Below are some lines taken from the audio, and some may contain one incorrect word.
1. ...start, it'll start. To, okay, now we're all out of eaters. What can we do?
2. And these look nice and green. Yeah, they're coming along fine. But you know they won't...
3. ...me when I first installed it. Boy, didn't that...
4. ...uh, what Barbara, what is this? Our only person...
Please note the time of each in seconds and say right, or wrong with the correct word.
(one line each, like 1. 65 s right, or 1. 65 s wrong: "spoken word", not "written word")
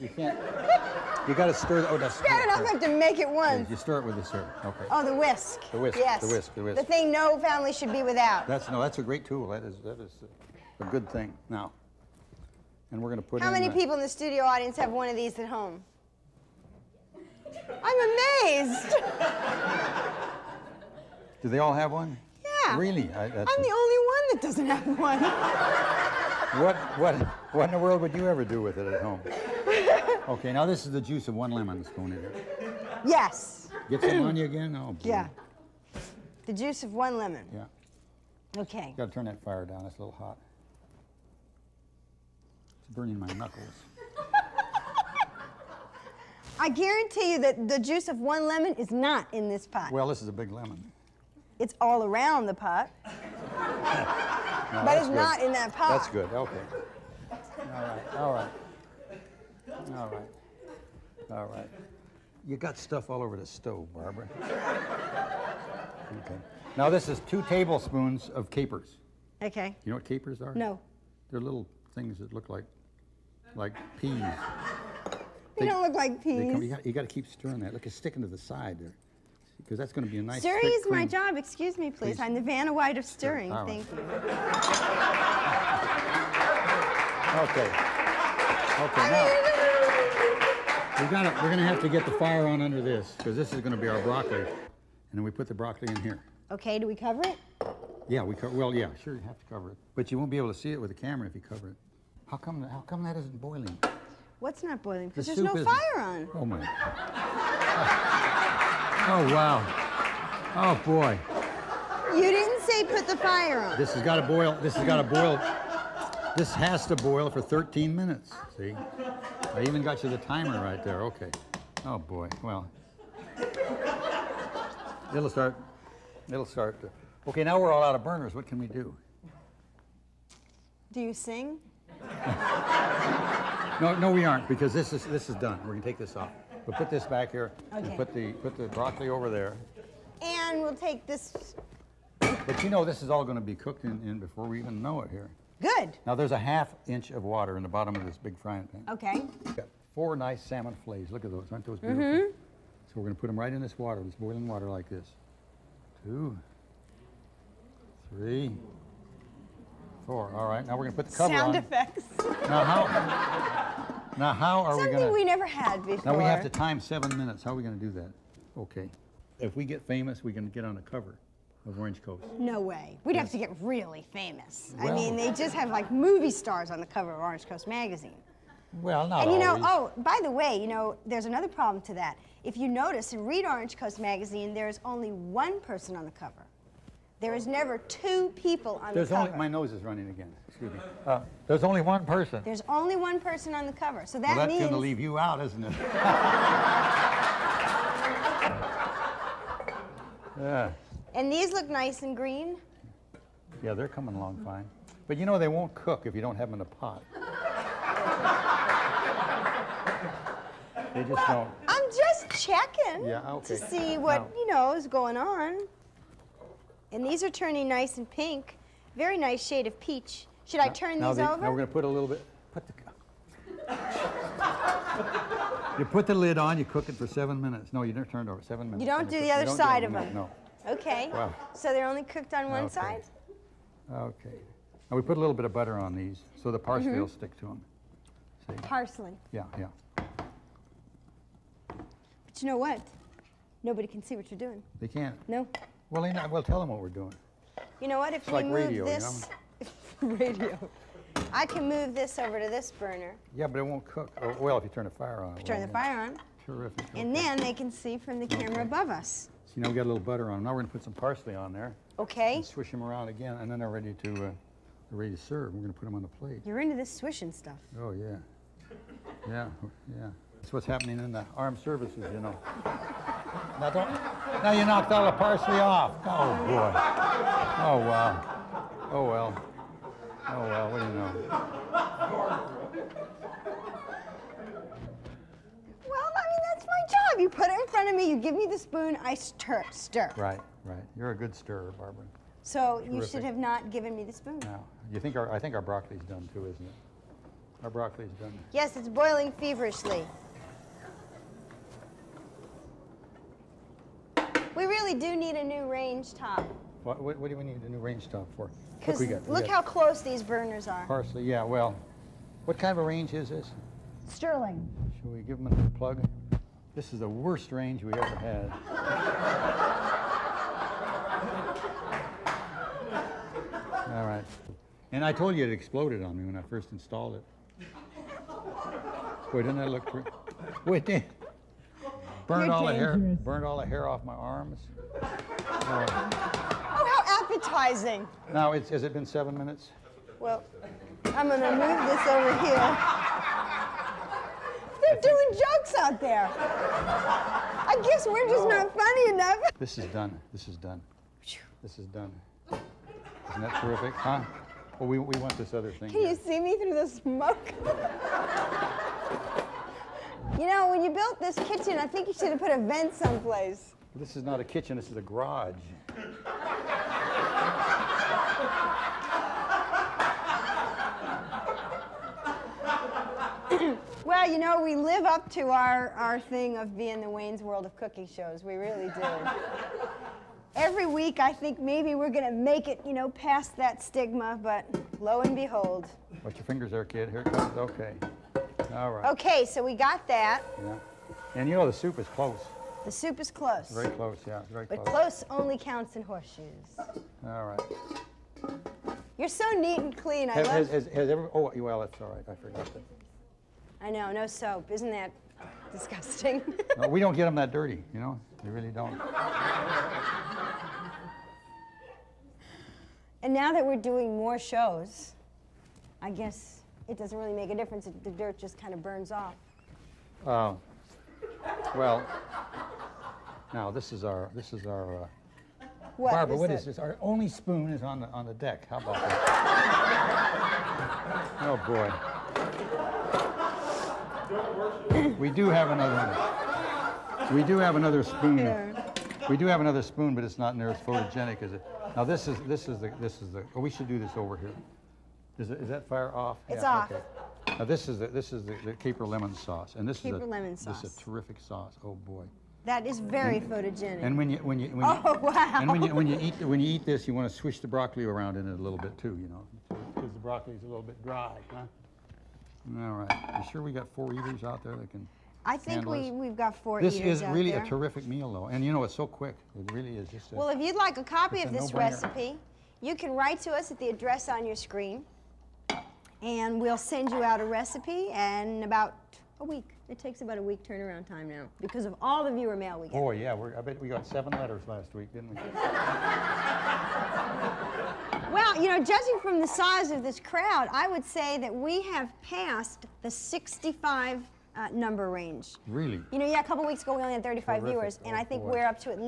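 1. 125 s wrong: "burners", not "eaters"
2. 201 s right
3. 326 s right
4. 425 s wrong: "spoon", not "person".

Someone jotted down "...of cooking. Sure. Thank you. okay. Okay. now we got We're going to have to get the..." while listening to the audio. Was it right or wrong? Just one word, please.
wrong.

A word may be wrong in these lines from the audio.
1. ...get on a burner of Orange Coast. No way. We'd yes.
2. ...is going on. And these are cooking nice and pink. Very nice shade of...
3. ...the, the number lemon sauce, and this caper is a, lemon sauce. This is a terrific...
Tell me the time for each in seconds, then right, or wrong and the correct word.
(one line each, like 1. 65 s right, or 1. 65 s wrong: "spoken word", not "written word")
1. 170 s wrong: "cover", not "burner"
2. 214 s wrong: "turning", not "cooking"
3. 448 s wrong: "caper", not "number".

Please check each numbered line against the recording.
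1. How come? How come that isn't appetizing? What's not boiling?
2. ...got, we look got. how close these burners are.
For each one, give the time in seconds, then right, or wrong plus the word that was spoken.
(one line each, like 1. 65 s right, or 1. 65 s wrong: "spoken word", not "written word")
1. 102 s wrong: "boiling", not "appetizing"
2. 309 s right.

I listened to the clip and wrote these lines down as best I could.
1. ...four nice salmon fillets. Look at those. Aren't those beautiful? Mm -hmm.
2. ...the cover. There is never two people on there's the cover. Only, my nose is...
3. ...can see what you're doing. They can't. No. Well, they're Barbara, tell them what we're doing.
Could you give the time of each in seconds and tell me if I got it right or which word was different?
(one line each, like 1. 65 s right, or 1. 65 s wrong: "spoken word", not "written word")
1. 149 s right
2. 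186 s right
3. 243 s wrong: "Well", not "Barbara".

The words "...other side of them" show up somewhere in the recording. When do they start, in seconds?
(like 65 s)
229 s.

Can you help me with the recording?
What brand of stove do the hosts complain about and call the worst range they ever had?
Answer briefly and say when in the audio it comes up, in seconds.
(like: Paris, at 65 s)
Sterling, at 314 s.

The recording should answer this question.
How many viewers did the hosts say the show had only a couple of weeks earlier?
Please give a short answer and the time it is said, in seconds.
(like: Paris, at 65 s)
35, at 497 s.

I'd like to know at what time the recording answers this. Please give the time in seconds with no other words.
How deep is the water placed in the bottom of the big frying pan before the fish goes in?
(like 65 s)
146 s.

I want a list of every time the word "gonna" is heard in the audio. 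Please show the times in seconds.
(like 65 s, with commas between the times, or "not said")
13 s, 135 s, 260 s, 265 s, 341 s.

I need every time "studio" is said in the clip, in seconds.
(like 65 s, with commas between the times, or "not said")
14 s.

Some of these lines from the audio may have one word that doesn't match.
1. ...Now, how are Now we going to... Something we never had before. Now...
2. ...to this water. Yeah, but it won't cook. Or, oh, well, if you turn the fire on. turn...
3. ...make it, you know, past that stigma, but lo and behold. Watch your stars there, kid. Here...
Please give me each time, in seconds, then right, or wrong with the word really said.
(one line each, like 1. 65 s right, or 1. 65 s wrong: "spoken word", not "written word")
1. 164 s wrong: "Something", not "Now"
2. 252 s wrong: "burner", not "water"
3. 382 s wrong: "fingers", not "stars".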